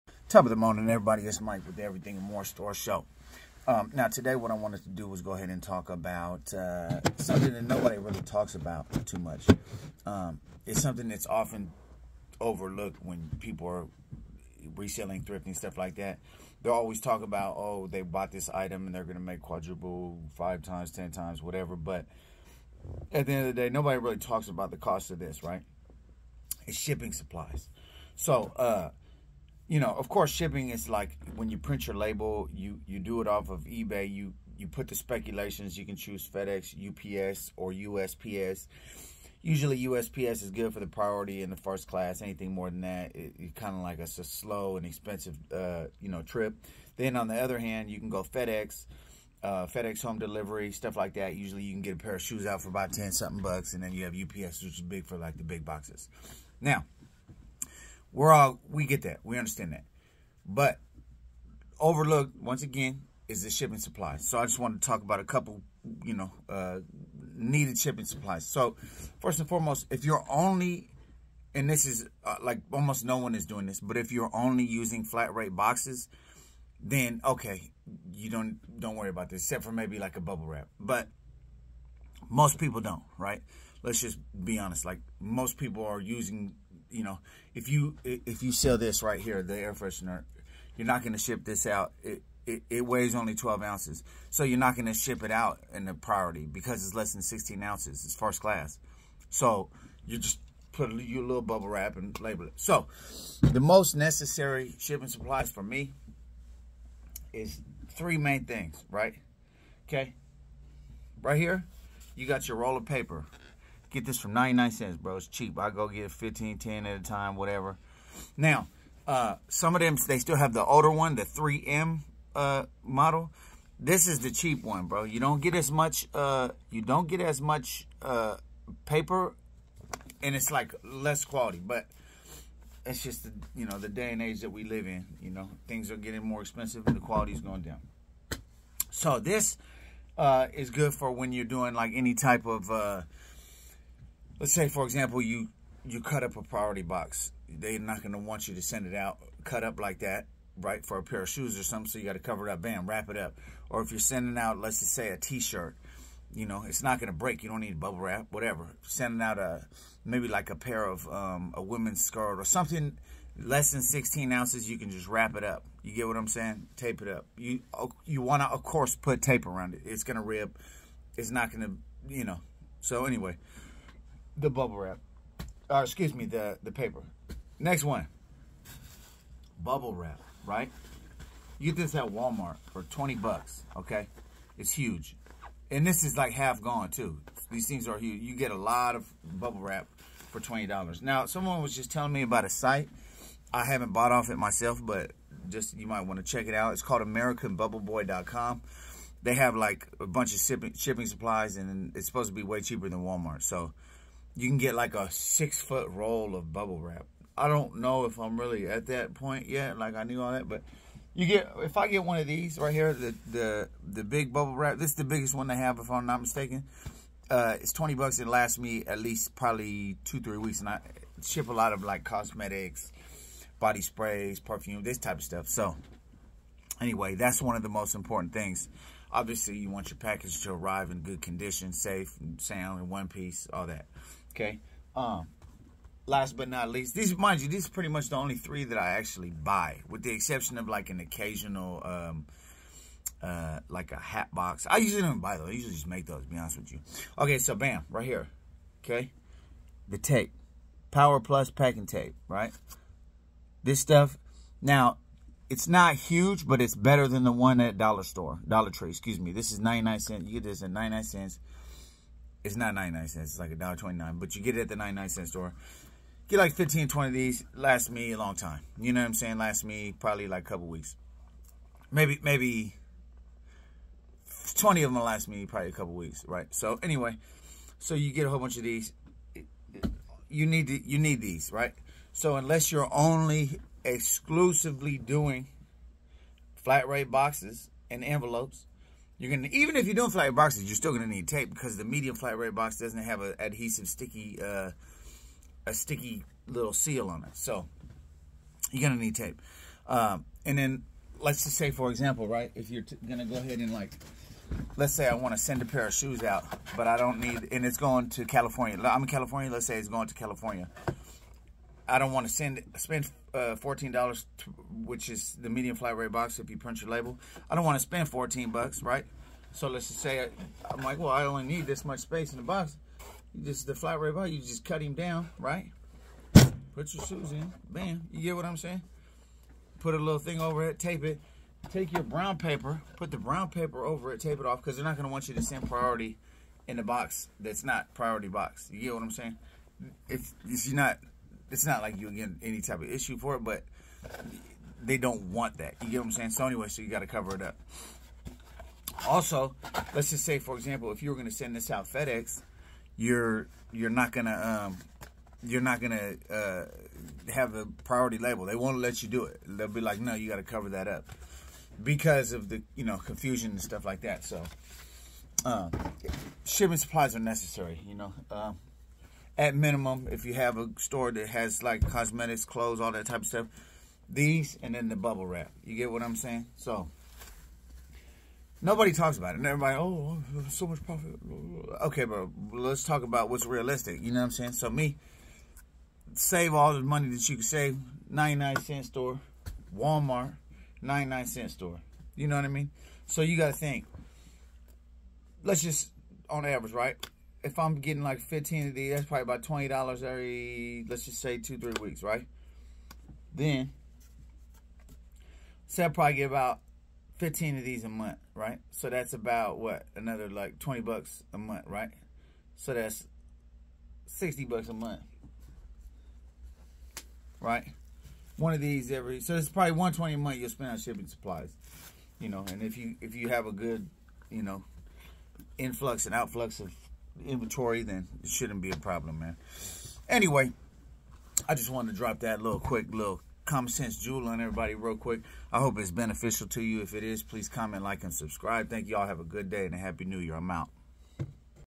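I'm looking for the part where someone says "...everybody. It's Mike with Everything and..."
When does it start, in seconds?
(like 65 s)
0 s.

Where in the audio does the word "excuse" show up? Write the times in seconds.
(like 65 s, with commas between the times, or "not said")
175 s, 258 s.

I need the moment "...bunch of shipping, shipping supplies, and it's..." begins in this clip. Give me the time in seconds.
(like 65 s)
200 s.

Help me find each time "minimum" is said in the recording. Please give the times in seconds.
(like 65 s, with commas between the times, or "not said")
369 s.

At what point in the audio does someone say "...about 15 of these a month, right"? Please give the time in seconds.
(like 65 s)
406 s.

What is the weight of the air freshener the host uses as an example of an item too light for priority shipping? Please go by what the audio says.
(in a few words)
12 ounces.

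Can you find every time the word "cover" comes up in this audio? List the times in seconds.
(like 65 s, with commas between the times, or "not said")
152 s, 347 s, 360 s.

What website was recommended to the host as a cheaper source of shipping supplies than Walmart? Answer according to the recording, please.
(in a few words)
AmericanBubbleBoy.com.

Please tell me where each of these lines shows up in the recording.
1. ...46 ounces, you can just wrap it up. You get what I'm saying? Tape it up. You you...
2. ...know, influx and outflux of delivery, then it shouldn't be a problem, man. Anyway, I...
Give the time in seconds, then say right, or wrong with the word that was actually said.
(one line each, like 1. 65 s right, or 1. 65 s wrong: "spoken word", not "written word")
1. 163 s wrong: "16", not "46"
2. 424 s wrong: "inventory", not "delivery".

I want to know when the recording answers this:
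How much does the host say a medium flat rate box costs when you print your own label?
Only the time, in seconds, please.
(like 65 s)
313 s.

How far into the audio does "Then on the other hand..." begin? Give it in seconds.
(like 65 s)
46 s.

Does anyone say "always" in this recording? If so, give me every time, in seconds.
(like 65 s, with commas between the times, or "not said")
16 s.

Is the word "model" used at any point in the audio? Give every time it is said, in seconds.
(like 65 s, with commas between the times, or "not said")
122 s.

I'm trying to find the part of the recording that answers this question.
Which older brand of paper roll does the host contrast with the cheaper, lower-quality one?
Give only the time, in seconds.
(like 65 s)
121 s.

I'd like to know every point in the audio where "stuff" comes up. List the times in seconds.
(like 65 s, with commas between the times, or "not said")
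15 s, 50 s, 225 s, 253 s, 363 s, 373 s.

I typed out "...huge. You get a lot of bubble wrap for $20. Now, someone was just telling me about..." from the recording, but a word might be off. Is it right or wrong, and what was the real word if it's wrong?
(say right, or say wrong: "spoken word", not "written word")
right.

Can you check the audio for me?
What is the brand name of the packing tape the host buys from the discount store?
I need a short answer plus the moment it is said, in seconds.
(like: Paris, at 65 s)
Power Plus, at 250 s.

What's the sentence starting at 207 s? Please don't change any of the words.
I don't know if I'm really at that point yet.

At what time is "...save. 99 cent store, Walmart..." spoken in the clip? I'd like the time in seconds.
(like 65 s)
387 s.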